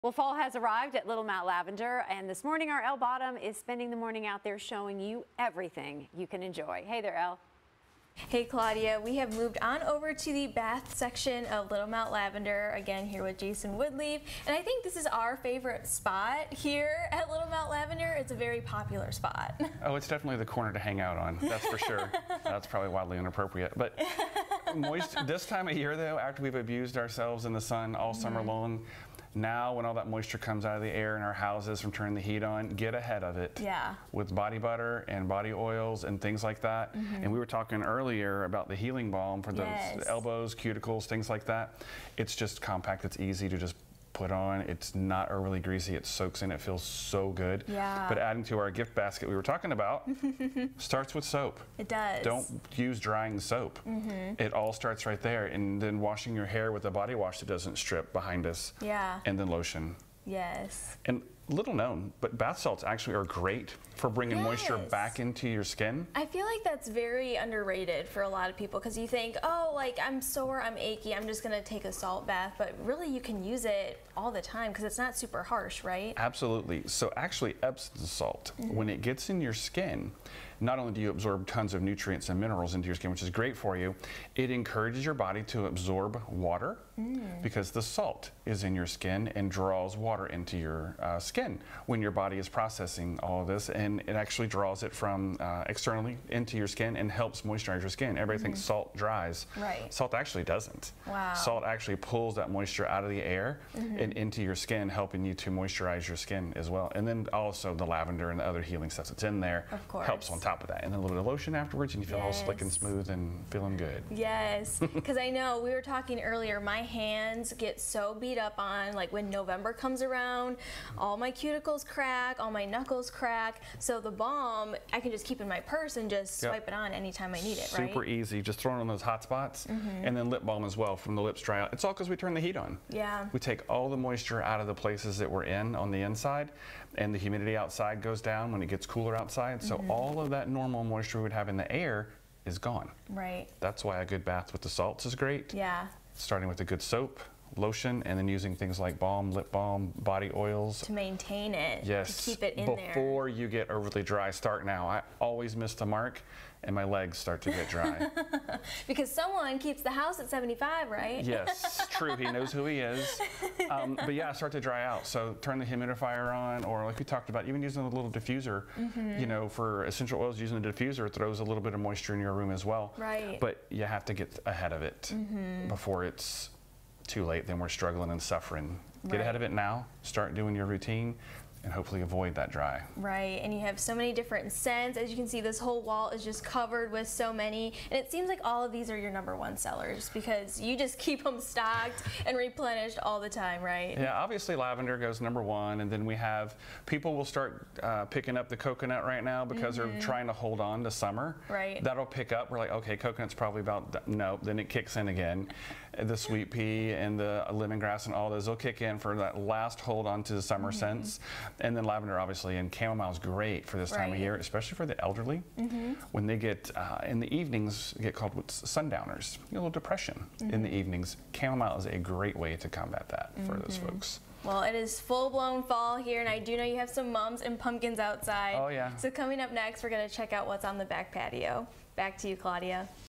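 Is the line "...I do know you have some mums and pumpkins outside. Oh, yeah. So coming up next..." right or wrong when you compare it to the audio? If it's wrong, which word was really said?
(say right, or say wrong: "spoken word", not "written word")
right.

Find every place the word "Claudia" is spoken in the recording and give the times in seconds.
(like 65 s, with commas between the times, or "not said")
8 s, 232 s.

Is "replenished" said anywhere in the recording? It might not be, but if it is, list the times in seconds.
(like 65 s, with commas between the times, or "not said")
192 s.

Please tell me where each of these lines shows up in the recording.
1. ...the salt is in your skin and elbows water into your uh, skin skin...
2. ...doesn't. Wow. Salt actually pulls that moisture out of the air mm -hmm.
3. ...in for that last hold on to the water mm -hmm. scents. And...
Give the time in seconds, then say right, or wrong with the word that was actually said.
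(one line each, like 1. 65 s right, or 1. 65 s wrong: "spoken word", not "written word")
1. 87 s wrong: "draws", not "elbows"
2. 100 s right
3. 208 s wrong: "summer", not "water".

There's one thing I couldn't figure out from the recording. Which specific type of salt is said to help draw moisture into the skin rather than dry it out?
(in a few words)
Epsom salt.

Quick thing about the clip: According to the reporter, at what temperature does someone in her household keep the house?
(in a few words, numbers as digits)
75.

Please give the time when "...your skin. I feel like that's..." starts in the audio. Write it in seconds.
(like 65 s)
65 s.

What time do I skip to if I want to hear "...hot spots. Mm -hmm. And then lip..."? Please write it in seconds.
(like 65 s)
129 s.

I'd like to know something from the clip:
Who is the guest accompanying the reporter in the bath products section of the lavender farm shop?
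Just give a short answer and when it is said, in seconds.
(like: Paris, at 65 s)
Jason Woodleaf, at 13 s.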